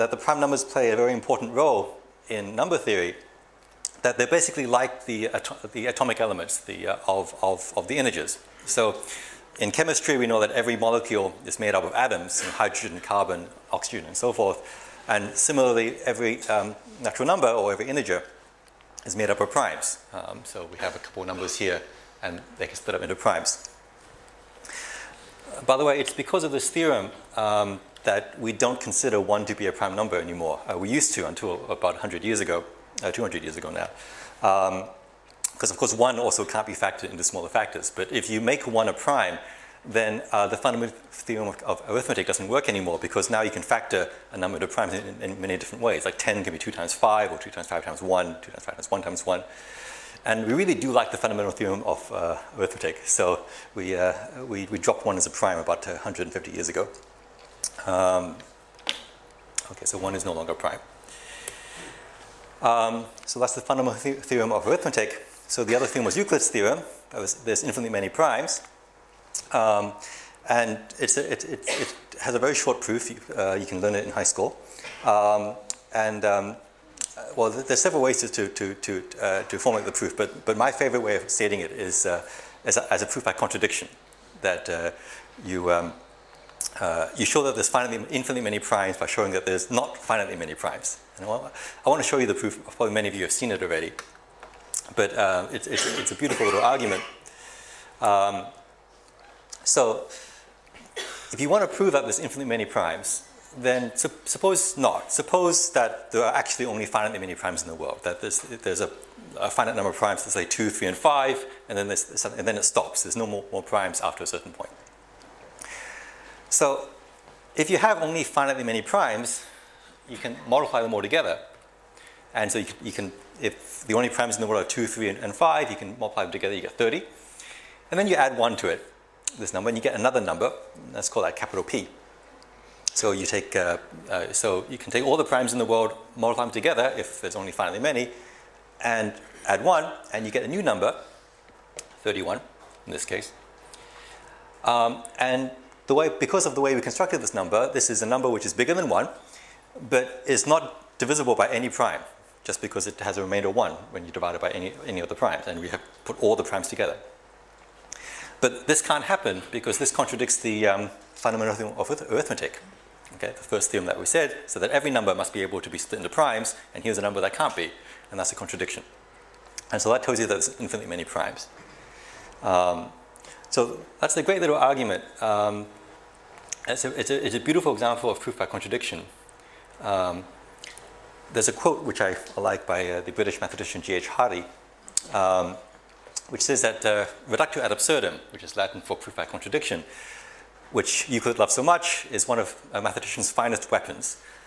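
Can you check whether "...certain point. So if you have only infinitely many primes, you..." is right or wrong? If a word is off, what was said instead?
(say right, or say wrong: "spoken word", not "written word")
wrong: "finitely", not "infinitely".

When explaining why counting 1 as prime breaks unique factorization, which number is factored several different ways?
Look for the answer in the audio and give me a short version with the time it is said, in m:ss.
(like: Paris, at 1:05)
10, at 0:46.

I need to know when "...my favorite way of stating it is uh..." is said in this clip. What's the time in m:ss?
1:20.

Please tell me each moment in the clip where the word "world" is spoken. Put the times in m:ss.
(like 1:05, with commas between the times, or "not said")
1:47, 2:04, 2:15.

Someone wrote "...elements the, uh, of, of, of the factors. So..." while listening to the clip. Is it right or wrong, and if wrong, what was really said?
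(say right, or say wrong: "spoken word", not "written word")
wrong: "integers", not "factors".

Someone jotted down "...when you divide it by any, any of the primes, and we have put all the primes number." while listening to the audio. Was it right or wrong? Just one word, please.
wrong.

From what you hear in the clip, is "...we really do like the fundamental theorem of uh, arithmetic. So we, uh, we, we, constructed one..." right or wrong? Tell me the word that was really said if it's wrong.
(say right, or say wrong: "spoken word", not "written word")
wrong: "dropped", not "constructed".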